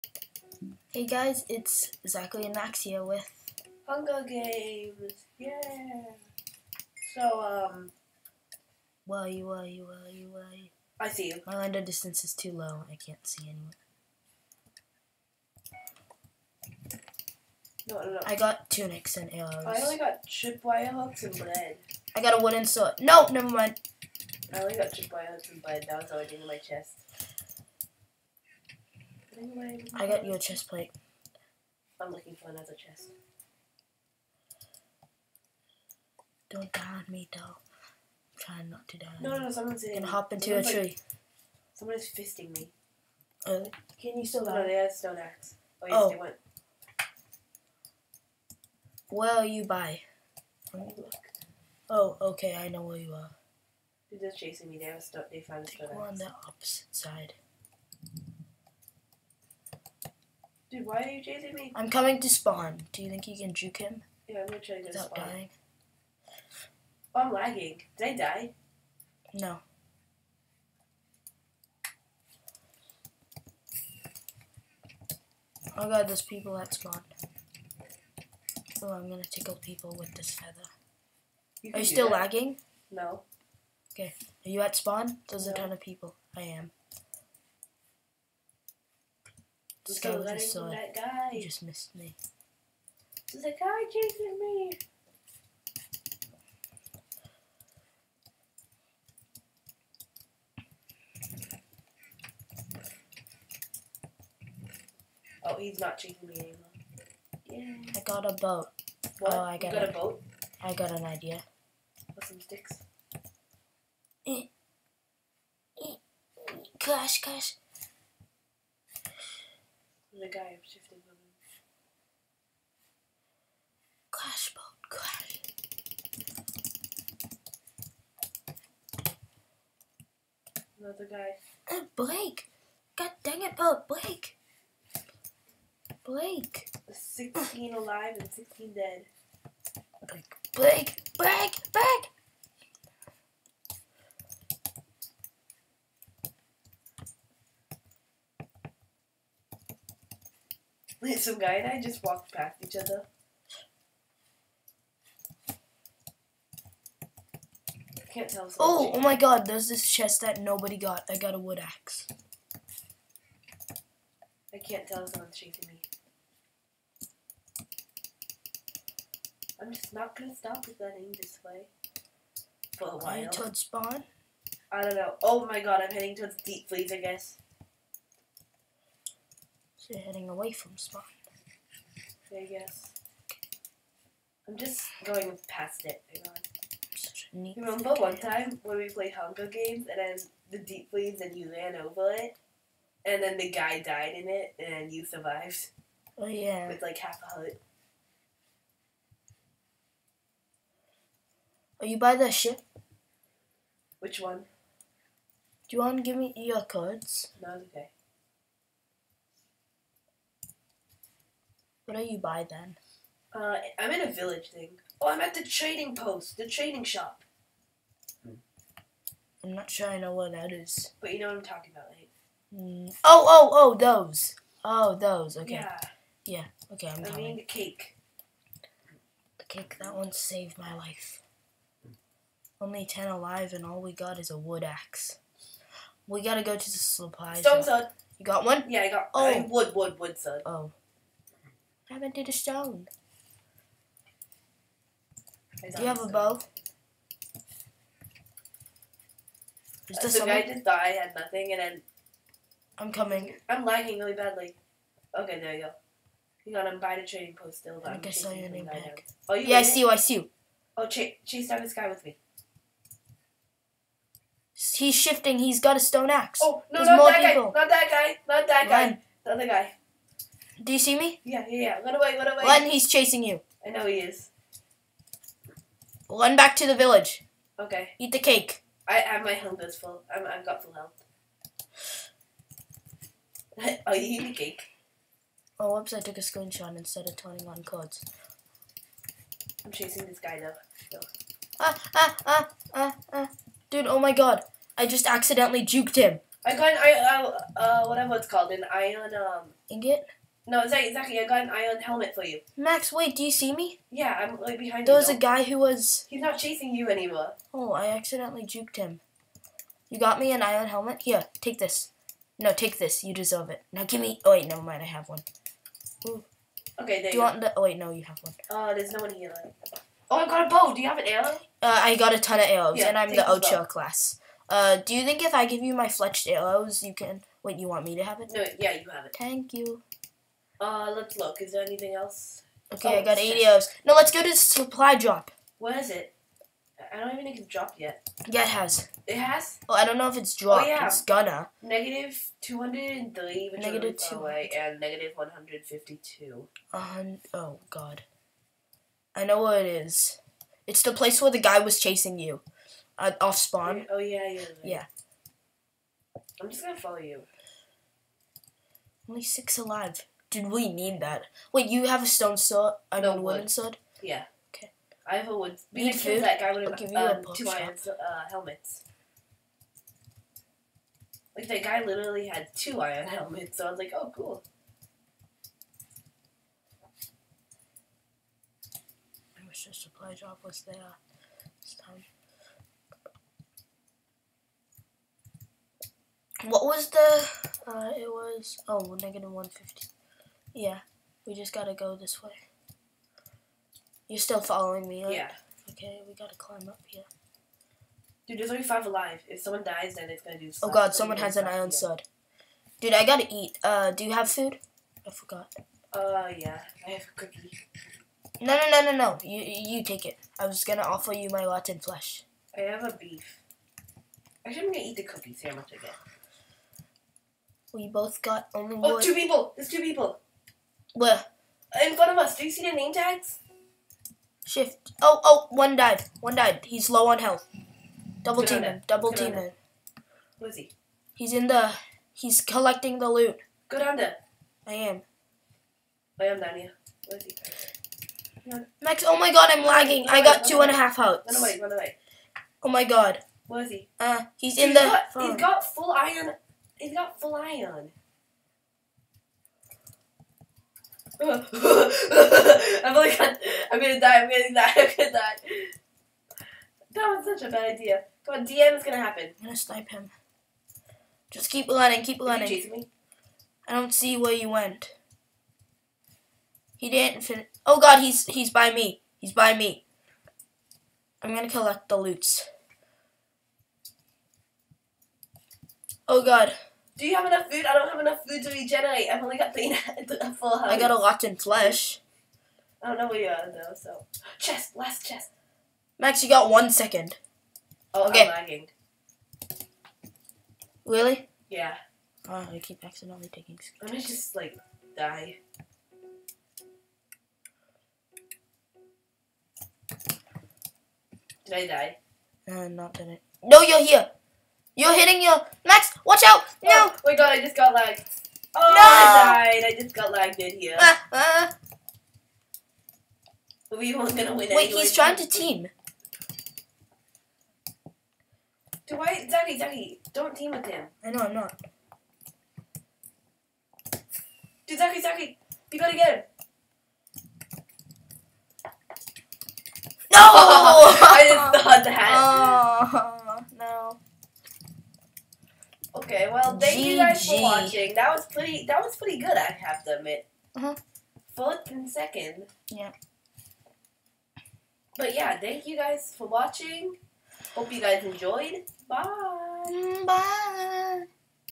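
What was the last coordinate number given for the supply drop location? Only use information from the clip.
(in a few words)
-152.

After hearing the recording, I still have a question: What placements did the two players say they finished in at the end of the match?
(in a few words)
Fourth and second.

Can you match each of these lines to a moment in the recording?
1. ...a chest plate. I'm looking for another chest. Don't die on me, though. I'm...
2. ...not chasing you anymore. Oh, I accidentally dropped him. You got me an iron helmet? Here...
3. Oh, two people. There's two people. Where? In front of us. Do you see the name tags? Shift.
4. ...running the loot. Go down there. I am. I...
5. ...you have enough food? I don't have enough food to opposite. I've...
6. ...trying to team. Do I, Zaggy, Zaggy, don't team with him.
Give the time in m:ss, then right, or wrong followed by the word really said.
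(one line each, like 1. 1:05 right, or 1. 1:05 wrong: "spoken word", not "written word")
1. 0:30 right
2. 5:06 wrong: "juked", not "dropped"
3. 6:58 right
4. 7:12 wrong: "collecting", not "running"
5. 7:57 wrong: "regenerate", not "opposite"
6. 8:34 right.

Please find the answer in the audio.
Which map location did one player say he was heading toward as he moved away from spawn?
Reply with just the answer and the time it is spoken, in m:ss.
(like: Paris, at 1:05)
Deep freeze, at 2:56.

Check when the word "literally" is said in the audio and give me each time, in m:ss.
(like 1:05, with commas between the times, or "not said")
6:11.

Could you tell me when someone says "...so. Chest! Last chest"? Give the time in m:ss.
8:03.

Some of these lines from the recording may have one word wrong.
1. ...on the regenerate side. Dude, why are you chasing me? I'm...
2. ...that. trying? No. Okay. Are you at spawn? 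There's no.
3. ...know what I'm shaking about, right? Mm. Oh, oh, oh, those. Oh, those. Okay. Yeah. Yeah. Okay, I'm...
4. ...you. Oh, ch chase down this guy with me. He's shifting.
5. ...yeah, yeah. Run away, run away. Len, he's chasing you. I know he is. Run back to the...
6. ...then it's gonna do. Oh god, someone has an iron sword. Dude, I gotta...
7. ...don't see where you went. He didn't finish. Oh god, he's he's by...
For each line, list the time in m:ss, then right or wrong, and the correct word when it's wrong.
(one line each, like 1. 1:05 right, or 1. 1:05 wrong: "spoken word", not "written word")
1. 0:56 wrong: "opposite", not "regenerate"
2. 1:22 wrong: "lagging", not "trying"
3. 3:41 wrong: "talking", not "shaking"
4. 4:20 right
5. 4:31 right
6. 6:39 right
7. 7:43 right.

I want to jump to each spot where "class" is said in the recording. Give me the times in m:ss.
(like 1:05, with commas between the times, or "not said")
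5:23.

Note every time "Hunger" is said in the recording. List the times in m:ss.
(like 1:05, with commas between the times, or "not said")
0:03, 3:09.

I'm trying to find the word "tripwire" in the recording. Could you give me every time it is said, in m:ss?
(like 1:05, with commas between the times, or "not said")
0:20, 0:24.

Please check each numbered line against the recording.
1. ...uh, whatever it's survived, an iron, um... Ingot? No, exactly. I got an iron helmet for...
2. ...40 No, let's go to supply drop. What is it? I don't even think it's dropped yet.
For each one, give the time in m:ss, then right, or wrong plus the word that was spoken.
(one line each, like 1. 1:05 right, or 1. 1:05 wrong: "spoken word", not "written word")
1. 4:57 wrong: "called", not "survived"
2. 5:33 wrong: "80", not "40".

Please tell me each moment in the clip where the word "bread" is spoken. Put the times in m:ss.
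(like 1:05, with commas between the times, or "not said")
0:21, 0:25.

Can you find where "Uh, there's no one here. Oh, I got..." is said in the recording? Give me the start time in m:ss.
5:18.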